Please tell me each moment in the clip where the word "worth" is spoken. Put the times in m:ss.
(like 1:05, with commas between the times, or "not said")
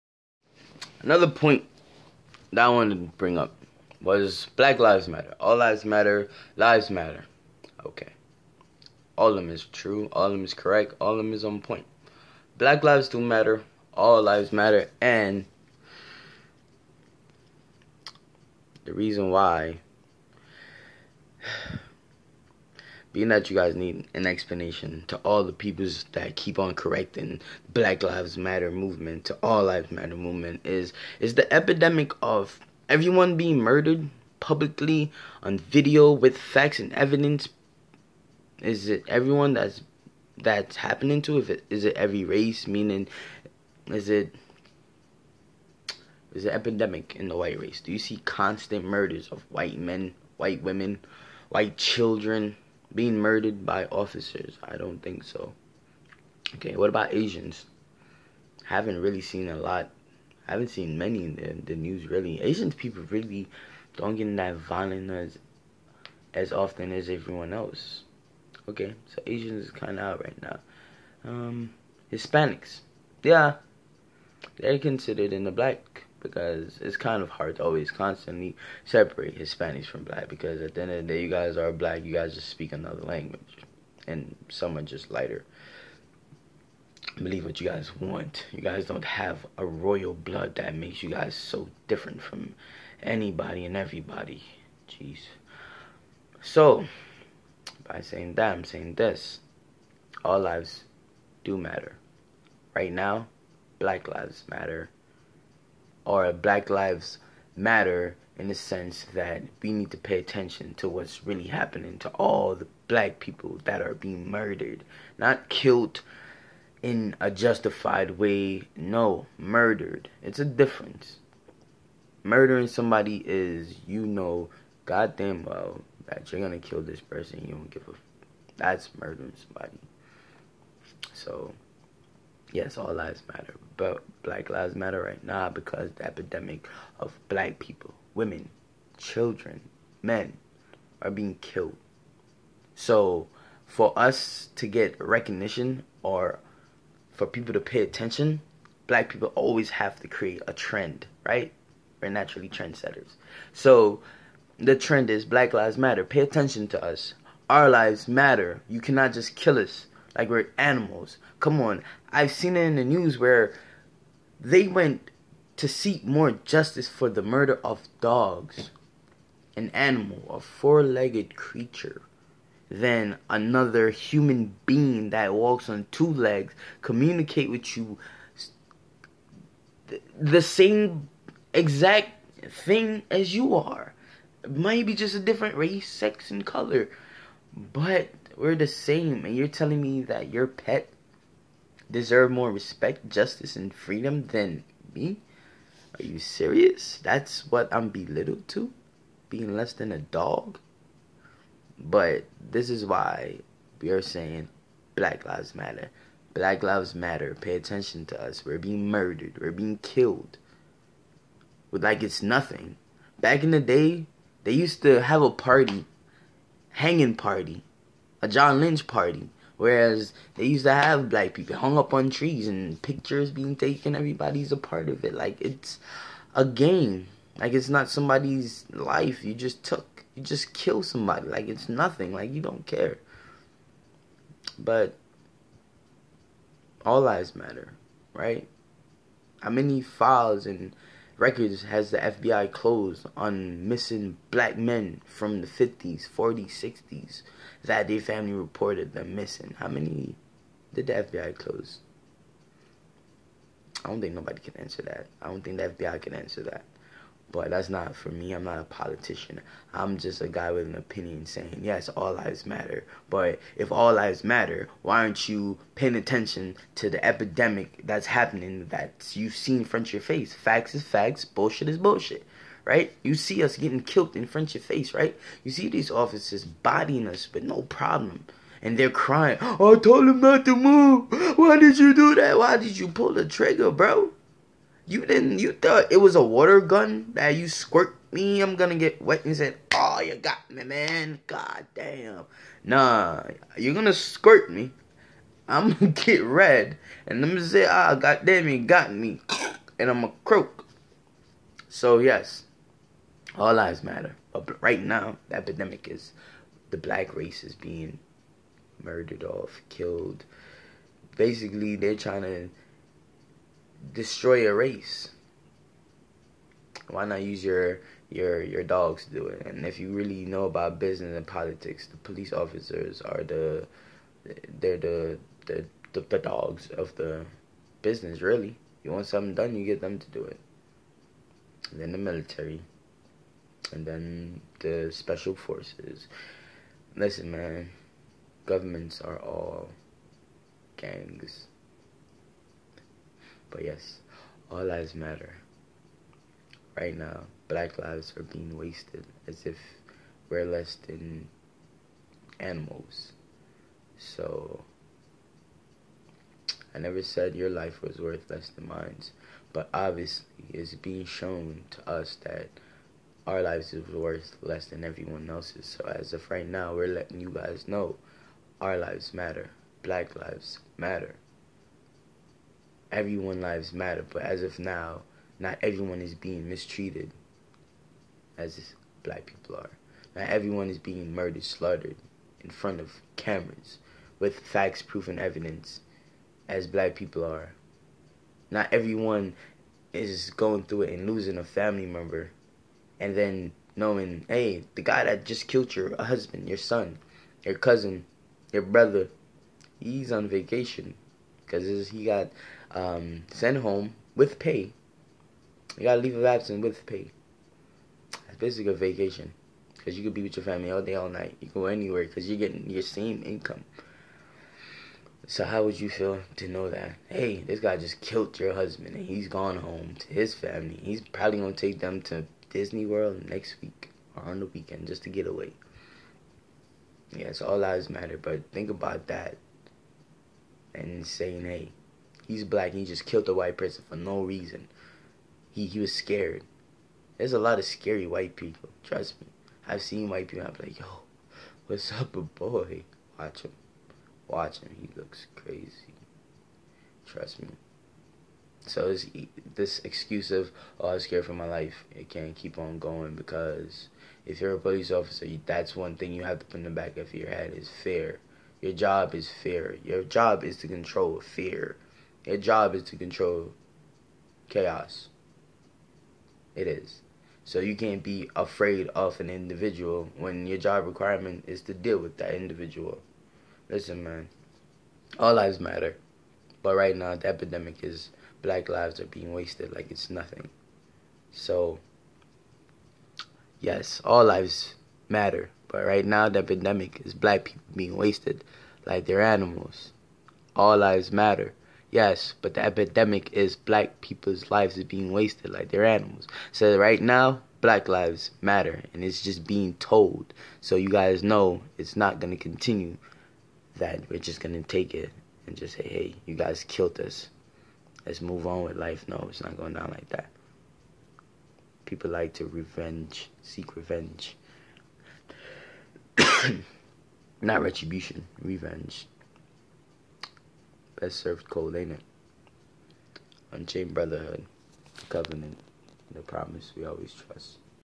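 5:57, 6:03.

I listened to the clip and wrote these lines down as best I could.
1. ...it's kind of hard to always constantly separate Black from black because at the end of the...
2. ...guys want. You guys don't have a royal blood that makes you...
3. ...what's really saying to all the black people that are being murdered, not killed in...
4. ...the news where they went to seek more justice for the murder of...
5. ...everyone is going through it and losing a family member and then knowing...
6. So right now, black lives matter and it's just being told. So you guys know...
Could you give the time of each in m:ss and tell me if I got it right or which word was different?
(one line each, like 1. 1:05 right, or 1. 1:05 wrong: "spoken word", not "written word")
1. 1:16 wrong: "Hispanics", not "Black"
2. 1:27 right
3. 1:50 wrong: "happening", not "saying"
4. 2:42 right
5. 6:28 right
6. 8:16 right.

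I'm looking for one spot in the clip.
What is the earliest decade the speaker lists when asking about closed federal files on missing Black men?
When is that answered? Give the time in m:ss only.
4:06.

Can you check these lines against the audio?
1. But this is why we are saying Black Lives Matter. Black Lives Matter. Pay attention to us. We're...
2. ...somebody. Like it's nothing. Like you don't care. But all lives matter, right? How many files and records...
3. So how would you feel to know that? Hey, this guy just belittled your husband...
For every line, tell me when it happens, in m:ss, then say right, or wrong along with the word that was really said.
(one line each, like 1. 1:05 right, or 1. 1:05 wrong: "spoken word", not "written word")
1. 3:21 right
2. 3:50 right
3. 6:55 wrong: "killed", not "belittled".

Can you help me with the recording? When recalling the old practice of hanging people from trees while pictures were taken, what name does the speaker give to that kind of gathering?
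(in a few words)
John Lynch party.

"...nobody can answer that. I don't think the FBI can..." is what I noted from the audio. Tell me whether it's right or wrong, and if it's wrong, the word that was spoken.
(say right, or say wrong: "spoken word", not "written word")
right.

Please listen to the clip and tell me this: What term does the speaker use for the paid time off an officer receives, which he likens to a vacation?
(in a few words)
leave of absence.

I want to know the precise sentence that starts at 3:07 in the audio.
But we're the same, and you're telling me that your pet deserve more respect, justice, and freedom than me?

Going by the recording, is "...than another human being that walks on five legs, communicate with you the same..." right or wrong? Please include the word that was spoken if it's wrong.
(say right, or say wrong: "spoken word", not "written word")
wrong: "two", not "five".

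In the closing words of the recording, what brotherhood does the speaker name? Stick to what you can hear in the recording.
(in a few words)
Unchained Brotherhood.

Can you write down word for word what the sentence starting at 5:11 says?
Basically, they're trying to destroy a race?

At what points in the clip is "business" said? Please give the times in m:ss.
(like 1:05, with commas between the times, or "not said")
5:20, 5:27.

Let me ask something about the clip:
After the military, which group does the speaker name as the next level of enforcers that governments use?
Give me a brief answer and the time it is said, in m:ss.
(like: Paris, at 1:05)
special forces, at 5:34.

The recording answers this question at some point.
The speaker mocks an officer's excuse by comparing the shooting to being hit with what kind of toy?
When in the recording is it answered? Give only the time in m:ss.
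4:46.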